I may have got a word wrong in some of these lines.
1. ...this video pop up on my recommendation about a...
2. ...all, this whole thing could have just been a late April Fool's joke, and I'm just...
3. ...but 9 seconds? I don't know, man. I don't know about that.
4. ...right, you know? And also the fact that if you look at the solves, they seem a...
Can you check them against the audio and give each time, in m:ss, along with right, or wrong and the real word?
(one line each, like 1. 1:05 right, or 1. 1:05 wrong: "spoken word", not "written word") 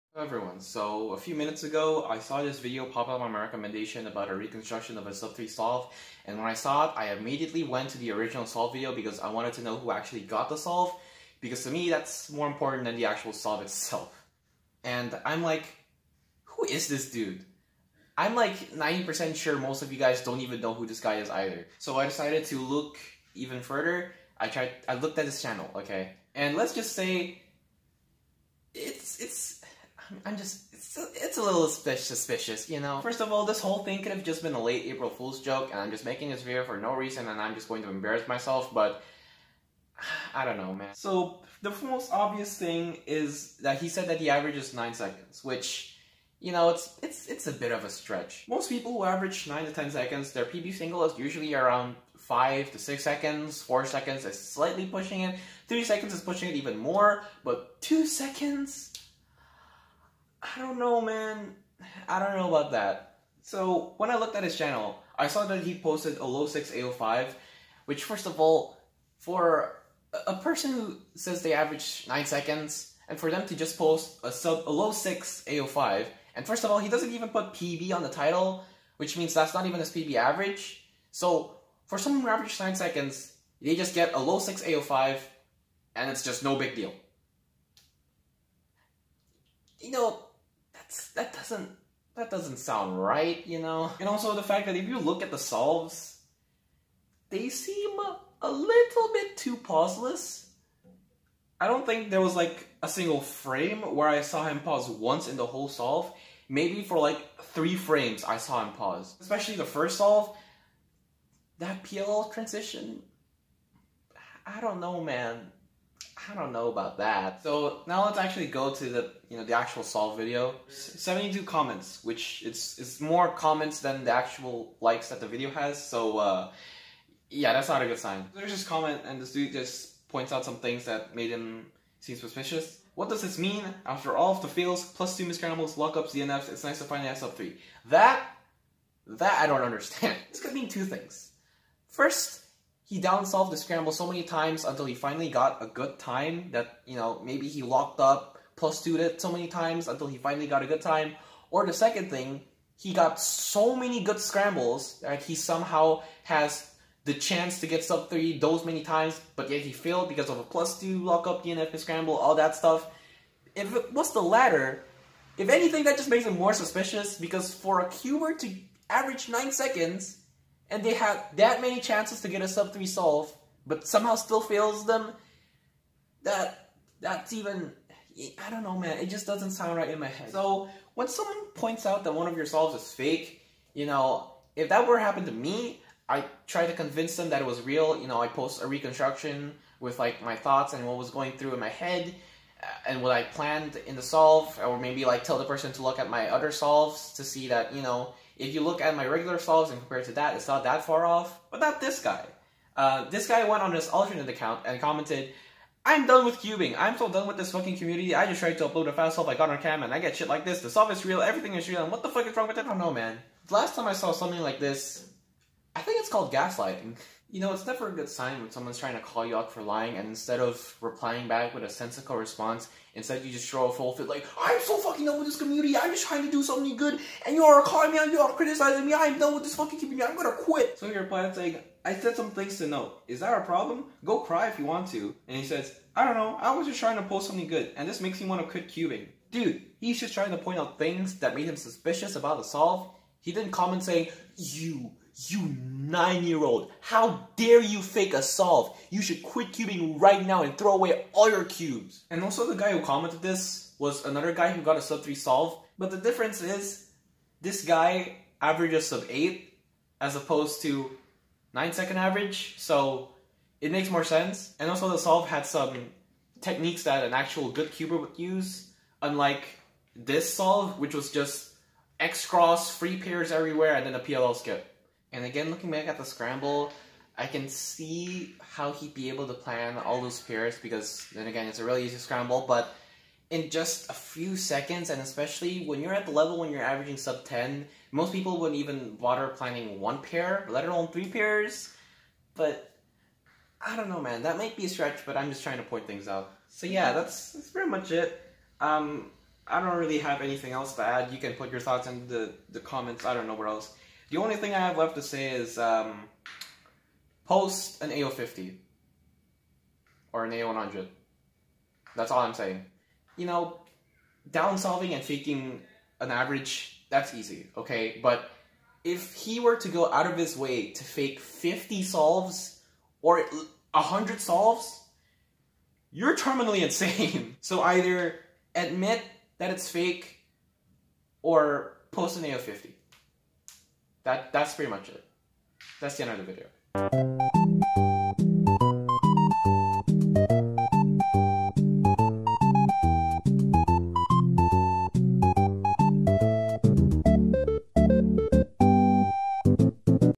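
1. 0:02 right
2. 0:33 right
3. 0:57 wrong: "2", not "9"
4. 1:33 right.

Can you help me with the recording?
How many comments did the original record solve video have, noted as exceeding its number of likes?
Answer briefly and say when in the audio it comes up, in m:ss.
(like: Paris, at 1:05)
72, at 2:00.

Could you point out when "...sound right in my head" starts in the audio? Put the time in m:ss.
2:59.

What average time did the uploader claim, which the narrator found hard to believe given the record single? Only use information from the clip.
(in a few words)
9 seconds.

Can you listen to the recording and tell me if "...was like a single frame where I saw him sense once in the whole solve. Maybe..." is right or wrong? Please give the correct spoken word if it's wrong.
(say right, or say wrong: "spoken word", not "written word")
wrong: "pause", not "sense".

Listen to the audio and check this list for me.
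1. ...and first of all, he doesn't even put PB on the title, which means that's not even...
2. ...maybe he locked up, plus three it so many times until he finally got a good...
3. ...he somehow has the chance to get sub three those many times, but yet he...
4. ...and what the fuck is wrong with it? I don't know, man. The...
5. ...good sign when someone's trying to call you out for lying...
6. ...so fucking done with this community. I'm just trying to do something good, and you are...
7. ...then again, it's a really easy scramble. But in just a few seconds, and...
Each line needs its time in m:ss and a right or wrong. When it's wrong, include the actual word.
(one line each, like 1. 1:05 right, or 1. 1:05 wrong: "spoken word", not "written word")
1. 1:16 right
2. 2:27 wrong: "two", not "three"
3. 2:35 right
4. 3:31 right
5. 3:37 right
6. 3:44 right
7. 4:41 right.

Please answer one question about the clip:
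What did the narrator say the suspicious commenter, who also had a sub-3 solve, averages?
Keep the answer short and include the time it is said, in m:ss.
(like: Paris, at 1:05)
sub 8, at 4:18.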